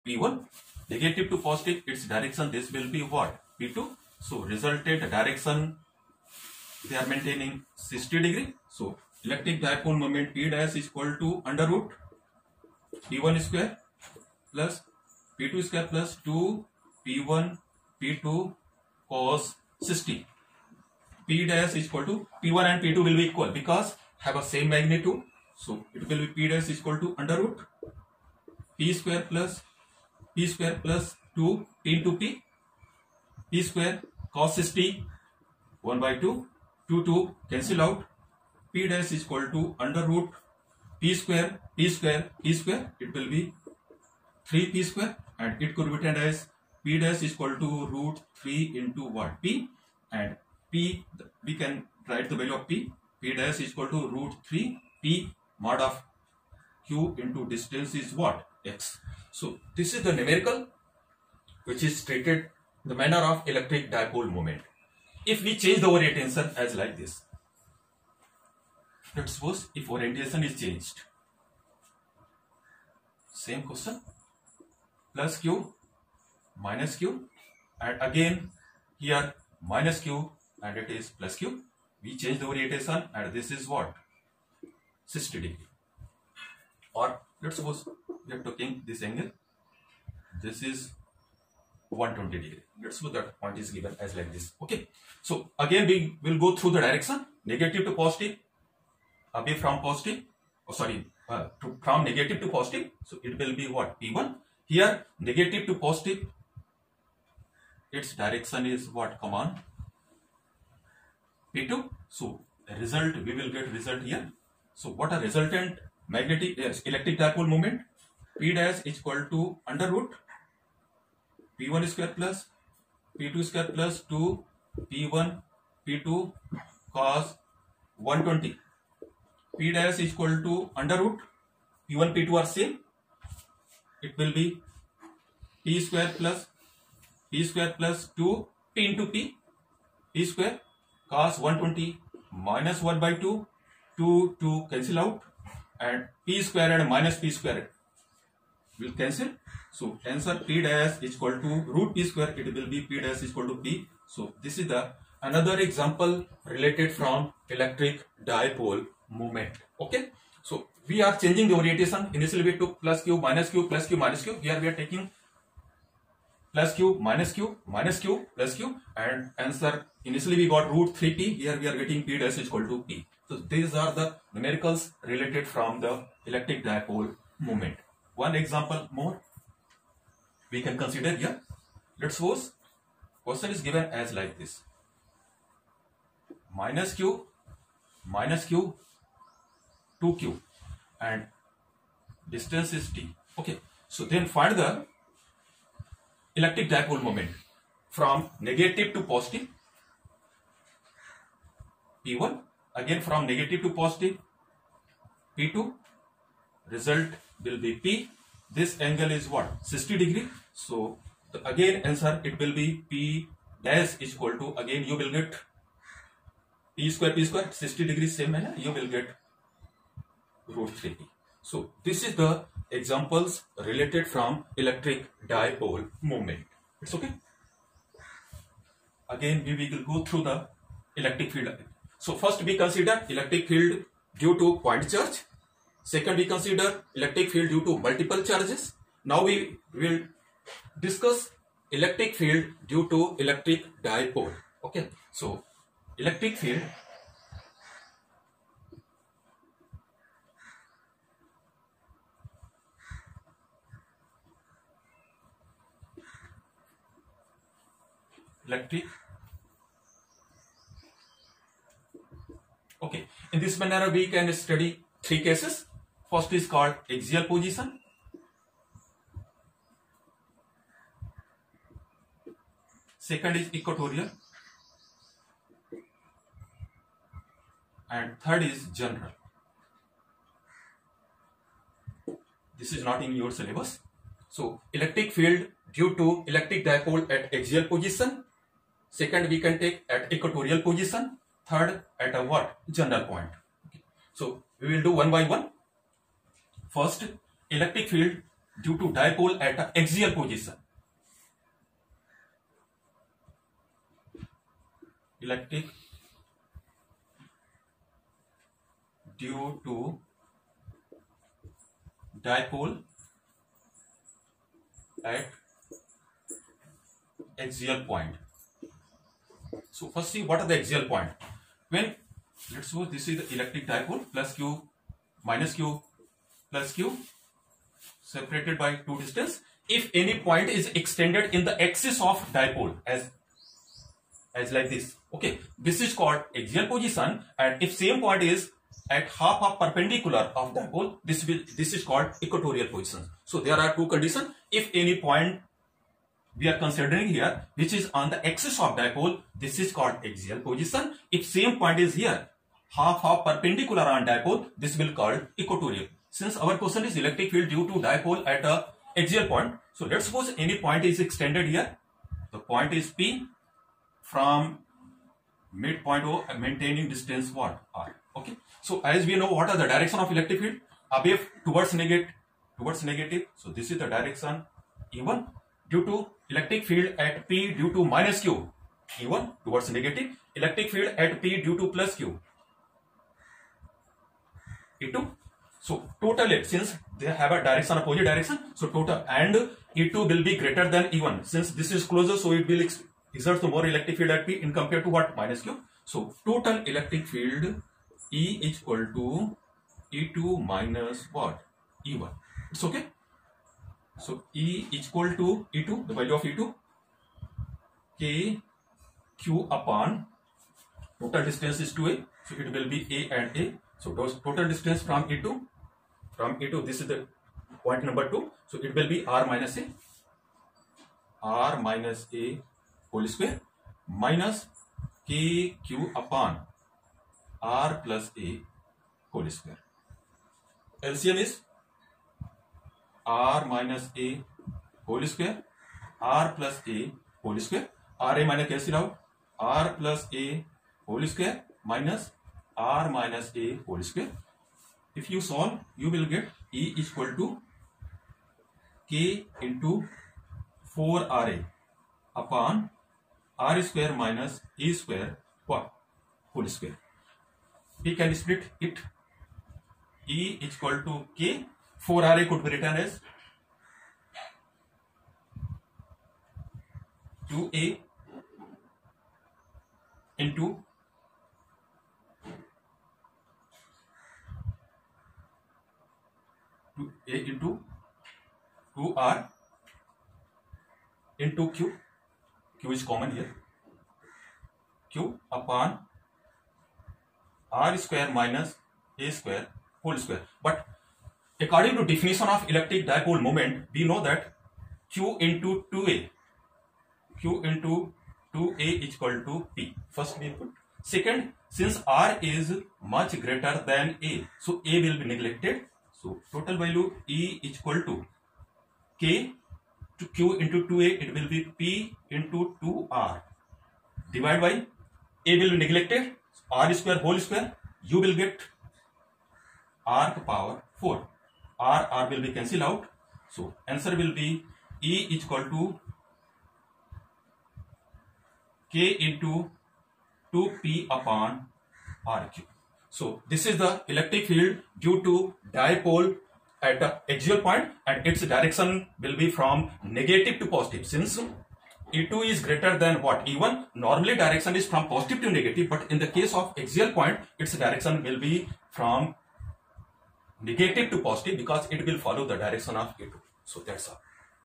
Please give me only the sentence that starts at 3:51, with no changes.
So first we consider electric field due to point charge Second, we consider electric field due to multiple charges.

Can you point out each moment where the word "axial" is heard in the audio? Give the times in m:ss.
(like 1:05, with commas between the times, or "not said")
4:26, 4:47, 5:36, 5:50, 5:59, 8:57, 9:06.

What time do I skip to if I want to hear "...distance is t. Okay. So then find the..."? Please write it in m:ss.
3:12.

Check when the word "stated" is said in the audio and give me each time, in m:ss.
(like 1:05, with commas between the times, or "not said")
1:02.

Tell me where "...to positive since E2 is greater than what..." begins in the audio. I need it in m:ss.
9:00.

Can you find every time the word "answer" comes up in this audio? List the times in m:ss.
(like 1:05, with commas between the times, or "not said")
2:30, 2:49, 3:31, 8:43.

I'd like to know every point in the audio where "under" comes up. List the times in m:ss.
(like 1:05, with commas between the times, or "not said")
0:11, 0:27, 0:39, 1:59, 2:10.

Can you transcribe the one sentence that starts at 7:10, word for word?
LCM is R minus A whole square R plus A whole square.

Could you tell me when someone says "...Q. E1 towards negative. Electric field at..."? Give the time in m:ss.
6:18.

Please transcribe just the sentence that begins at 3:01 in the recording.
Let's suppose question is given as like this.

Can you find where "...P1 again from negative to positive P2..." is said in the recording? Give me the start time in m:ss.
3:22.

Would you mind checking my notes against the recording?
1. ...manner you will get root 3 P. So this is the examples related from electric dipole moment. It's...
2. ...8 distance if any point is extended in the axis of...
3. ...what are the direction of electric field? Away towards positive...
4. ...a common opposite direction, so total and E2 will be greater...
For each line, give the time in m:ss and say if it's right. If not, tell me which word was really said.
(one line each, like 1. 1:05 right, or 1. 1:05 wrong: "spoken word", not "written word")
1. 3:38 right
2. 5:28 wrong: "2", not "8"
3. 6:09 wrong: "negative", not "positive"
4. 6:27 wrong: "direction", not "common".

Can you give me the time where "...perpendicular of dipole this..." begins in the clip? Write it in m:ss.
5:39.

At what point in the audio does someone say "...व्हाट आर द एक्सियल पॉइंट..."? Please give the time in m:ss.
5:20.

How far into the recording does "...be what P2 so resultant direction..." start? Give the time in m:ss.
0:02.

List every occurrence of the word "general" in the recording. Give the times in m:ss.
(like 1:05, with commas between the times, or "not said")
4:38, 4:52.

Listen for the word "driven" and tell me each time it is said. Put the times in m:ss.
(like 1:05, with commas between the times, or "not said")
not said.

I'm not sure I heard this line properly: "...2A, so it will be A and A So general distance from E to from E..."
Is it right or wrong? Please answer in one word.
wrong.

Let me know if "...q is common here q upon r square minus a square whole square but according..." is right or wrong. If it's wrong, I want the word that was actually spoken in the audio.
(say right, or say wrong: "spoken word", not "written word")
right.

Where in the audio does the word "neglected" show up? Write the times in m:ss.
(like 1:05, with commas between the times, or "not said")
8:25, 8:35.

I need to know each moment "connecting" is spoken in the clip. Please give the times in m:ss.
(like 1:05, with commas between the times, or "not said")
not said.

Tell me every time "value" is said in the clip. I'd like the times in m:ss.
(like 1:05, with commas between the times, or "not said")
0:52, 6:45, 8:26.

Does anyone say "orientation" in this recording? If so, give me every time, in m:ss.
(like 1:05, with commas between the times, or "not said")
1:05, 1:09, 1:22, 2:41.